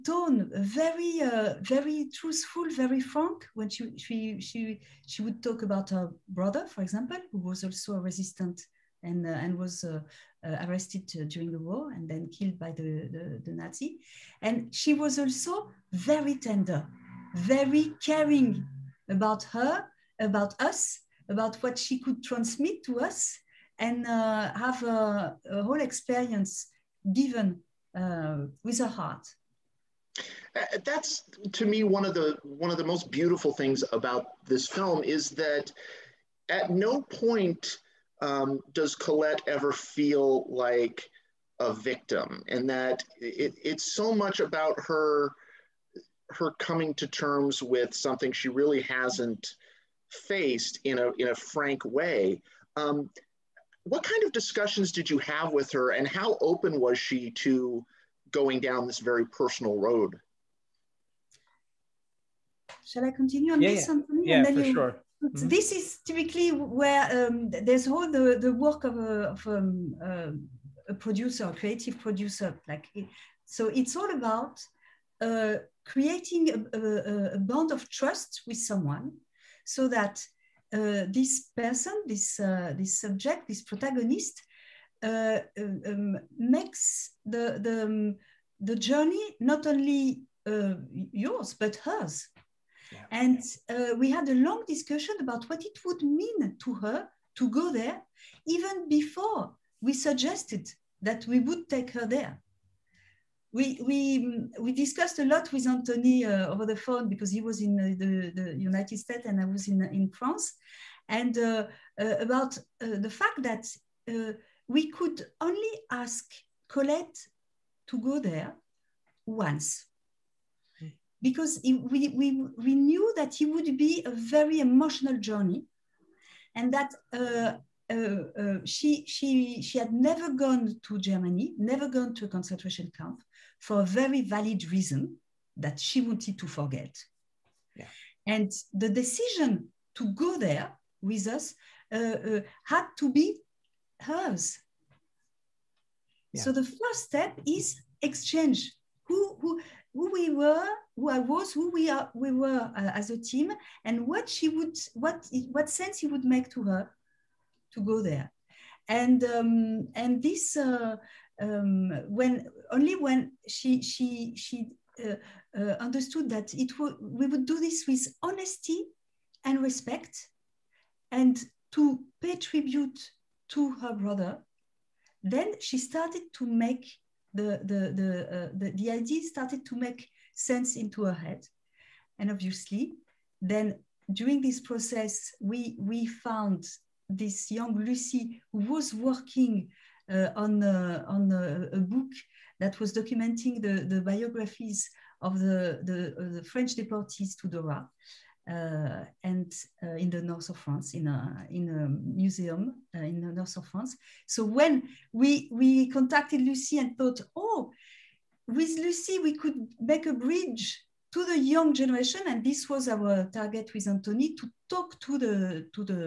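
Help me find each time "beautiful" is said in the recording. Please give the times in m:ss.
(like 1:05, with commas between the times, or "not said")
0:33.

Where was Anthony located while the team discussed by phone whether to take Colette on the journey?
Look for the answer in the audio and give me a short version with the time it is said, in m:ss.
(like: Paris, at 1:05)
United States, at 1:48.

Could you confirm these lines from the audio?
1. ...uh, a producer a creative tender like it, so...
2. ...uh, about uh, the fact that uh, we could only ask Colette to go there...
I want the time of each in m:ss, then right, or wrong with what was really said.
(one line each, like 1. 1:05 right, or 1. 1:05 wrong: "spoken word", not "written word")
1. 1:10 wrong: "producer", not "tender"
2. 1:51 right.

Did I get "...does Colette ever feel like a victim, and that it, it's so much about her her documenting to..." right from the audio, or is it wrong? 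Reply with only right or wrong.
wrong.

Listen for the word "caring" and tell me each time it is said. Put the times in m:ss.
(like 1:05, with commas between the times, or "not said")
0:18.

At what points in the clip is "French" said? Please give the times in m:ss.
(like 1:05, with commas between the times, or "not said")
3:16.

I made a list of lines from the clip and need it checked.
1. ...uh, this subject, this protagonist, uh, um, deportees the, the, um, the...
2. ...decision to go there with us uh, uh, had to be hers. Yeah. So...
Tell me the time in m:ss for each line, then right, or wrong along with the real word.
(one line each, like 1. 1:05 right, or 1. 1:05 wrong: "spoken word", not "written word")
1. 1:22 wrong: "makes", not "deportees"
2. 2:18 right.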